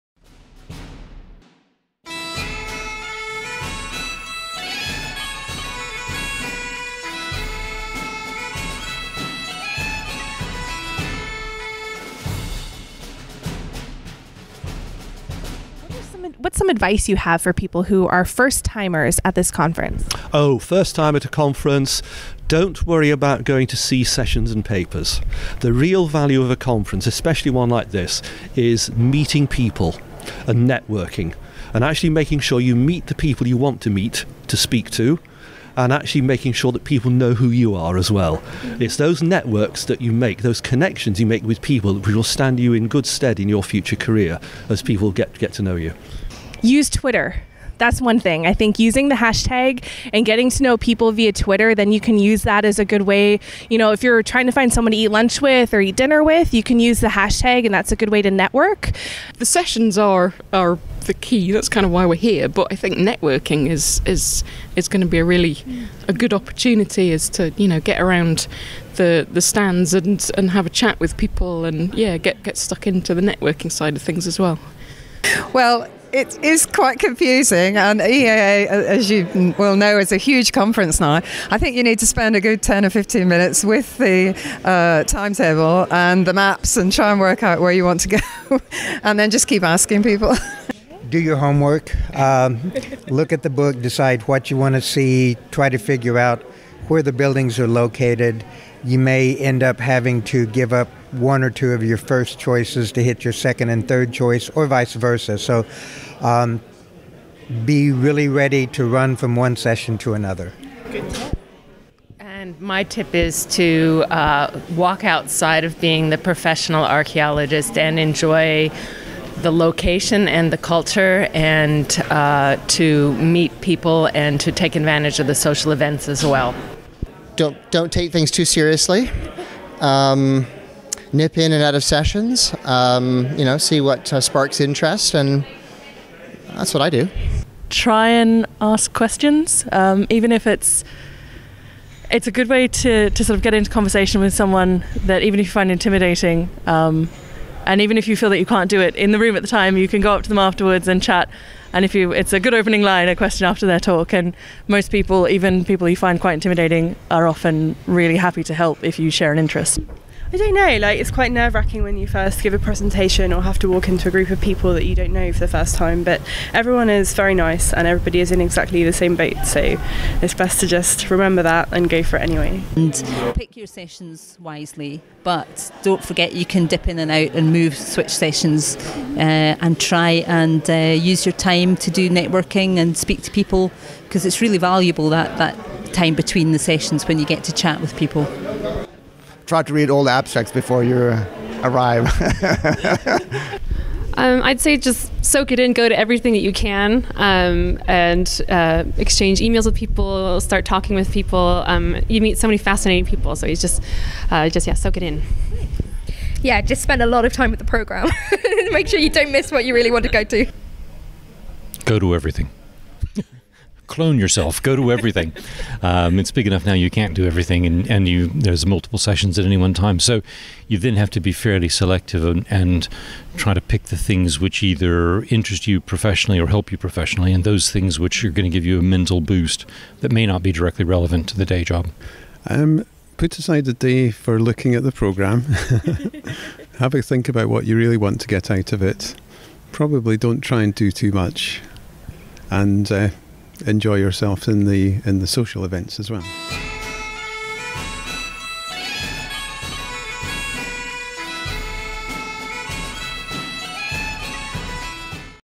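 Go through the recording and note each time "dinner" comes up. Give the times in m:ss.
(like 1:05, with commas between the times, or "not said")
0:55.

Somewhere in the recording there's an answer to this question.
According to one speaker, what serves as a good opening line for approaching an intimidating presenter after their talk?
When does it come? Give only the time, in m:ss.
2:33.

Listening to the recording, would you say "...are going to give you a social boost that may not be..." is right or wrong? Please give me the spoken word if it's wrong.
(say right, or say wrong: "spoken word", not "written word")
wrong: "mental", not "social".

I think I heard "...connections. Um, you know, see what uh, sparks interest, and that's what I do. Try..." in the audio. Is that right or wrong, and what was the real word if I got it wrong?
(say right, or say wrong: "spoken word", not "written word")
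wrong: "sessions", not "connections".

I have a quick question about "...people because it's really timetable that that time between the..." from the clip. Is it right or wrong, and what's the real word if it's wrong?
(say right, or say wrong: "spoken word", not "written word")
wrong: "valuable", not "timetable".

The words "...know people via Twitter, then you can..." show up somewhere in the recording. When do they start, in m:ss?
0:50.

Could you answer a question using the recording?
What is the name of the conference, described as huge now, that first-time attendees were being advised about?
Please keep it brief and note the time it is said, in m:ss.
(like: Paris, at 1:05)
EAA, at 1:18.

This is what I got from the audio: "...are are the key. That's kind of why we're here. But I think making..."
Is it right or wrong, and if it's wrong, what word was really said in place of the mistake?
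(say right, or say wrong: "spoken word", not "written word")
wrong: "networking", not "making".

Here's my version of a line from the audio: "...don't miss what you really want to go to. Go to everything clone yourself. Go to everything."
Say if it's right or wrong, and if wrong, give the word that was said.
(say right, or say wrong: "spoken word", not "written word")
right.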